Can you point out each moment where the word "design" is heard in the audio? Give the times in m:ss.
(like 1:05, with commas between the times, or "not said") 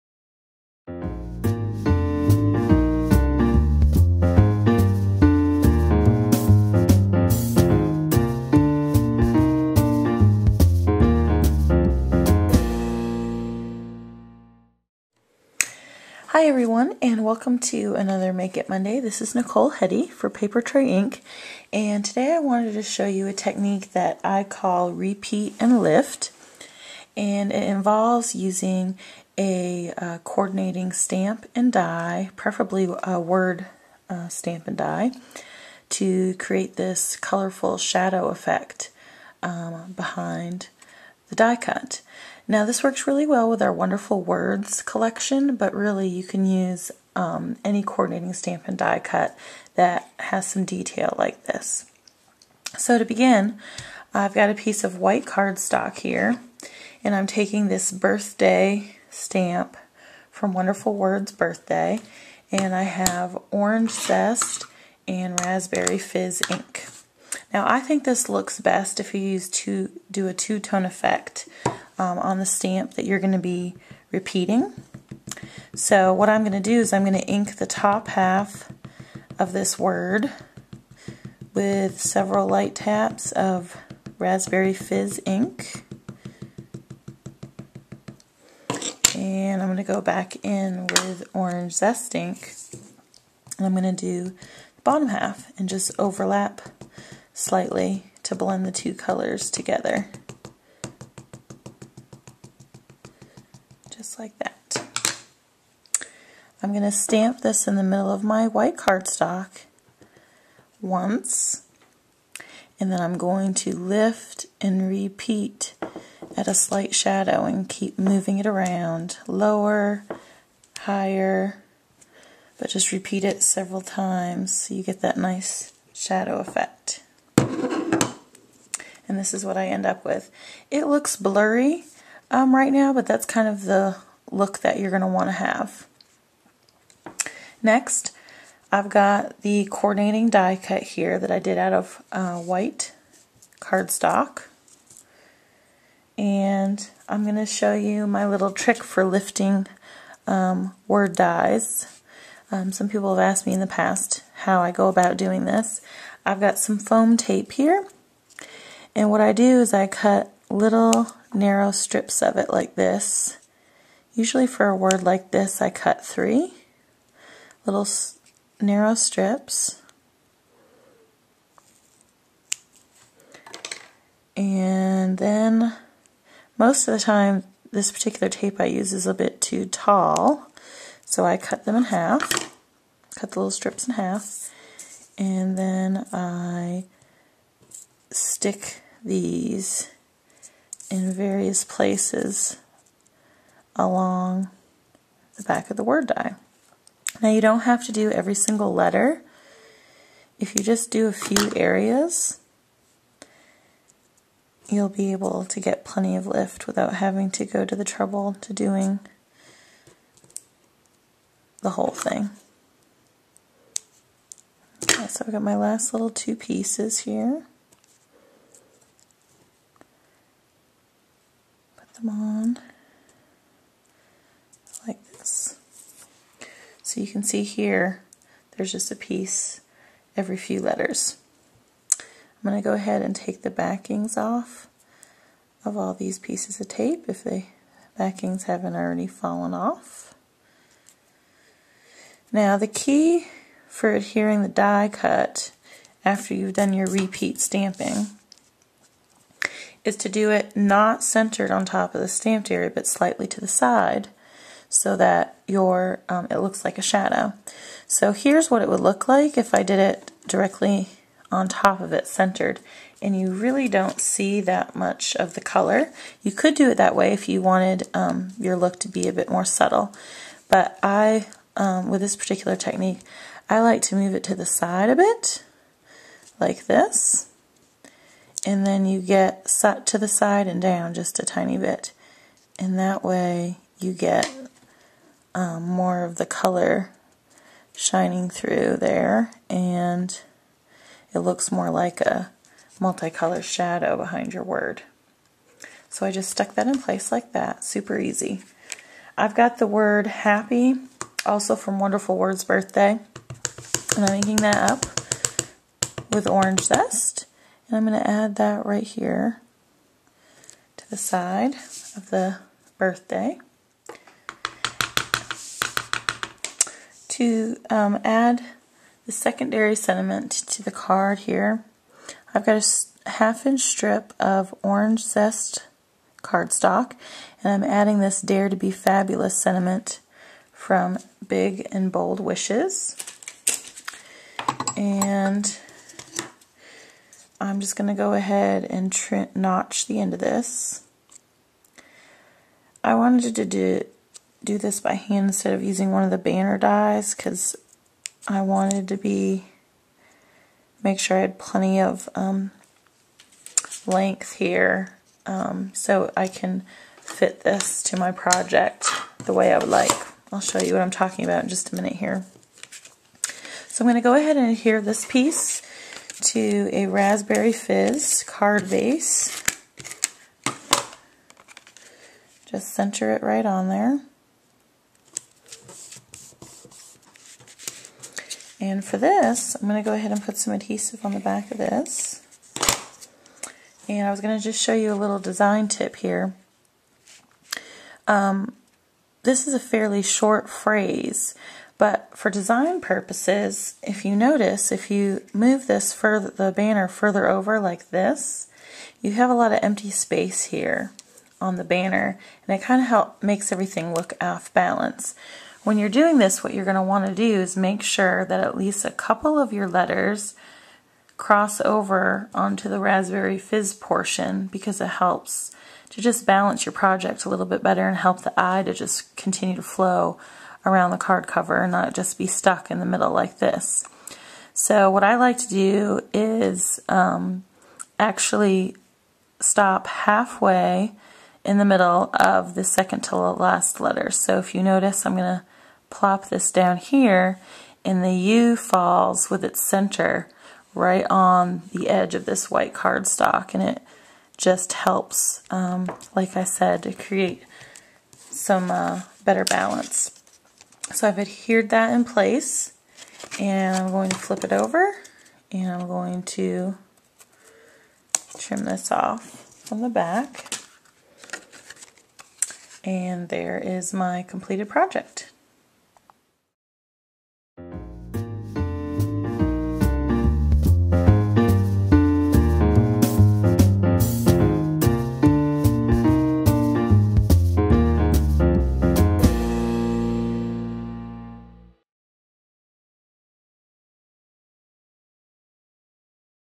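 6:25, 6:32.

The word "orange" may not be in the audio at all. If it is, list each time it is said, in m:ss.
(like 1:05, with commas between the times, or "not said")
1:03, 1:31, 5:06, 5:24.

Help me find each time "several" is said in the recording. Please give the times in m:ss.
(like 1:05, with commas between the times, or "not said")
1:22, 2:03.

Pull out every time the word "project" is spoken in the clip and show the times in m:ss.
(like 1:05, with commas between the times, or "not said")
5:58, 6:56, 7:44.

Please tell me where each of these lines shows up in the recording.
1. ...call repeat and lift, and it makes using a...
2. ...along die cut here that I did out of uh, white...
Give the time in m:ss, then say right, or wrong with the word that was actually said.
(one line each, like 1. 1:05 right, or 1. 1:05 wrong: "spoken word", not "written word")
1. 0:24 wrong: "involves", not "makes"
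2. 2:19 wrong: "coordinating", not "along".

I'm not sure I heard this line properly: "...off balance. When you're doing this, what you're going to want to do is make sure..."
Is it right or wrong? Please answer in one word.
right.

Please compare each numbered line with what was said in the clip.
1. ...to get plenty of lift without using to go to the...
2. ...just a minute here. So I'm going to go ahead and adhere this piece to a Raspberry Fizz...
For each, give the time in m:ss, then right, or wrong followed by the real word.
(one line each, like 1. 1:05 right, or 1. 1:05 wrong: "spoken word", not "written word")
1. 3:25 wrong: "having", not "using"
2. 6:01 right.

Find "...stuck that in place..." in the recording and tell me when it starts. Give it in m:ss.
4:56.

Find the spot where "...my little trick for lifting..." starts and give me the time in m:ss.
2:28.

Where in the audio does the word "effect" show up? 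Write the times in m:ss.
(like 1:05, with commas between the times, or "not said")
0:38, 1:10, 2:06.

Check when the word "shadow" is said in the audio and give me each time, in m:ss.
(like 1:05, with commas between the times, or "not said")
0:37, 1:56, 2:05, 4:16, 4:53.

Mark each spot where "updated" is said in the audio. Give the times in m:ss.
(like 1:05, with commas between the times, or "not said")
not said.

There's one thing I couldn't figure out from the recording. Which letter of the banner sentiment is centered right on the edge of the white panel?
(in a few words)
U.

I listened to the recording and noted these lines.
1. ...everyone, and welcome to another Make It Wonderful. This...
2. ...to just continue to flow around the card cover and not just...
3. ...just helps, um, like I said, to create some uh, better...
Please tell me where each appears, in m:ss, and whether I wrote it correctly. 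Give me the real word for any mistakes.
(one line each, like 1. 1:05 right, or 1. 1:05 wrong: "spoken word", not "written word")
1. 0:16 wrong: "Monday", not "Wonderful"
2. 6:58 right
3. 7:24 right.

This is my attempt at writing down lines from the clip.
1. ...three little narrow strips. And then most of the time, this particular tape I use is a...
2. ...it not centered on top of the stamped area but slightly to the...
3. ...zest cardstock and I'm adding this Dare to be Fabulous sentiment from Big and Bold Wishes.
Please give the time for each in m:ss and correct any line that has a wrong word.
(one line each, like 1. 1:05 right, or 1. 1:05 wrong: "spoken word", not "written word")
1. 2:46 right
2. 4:10 right
3. 5:25 right.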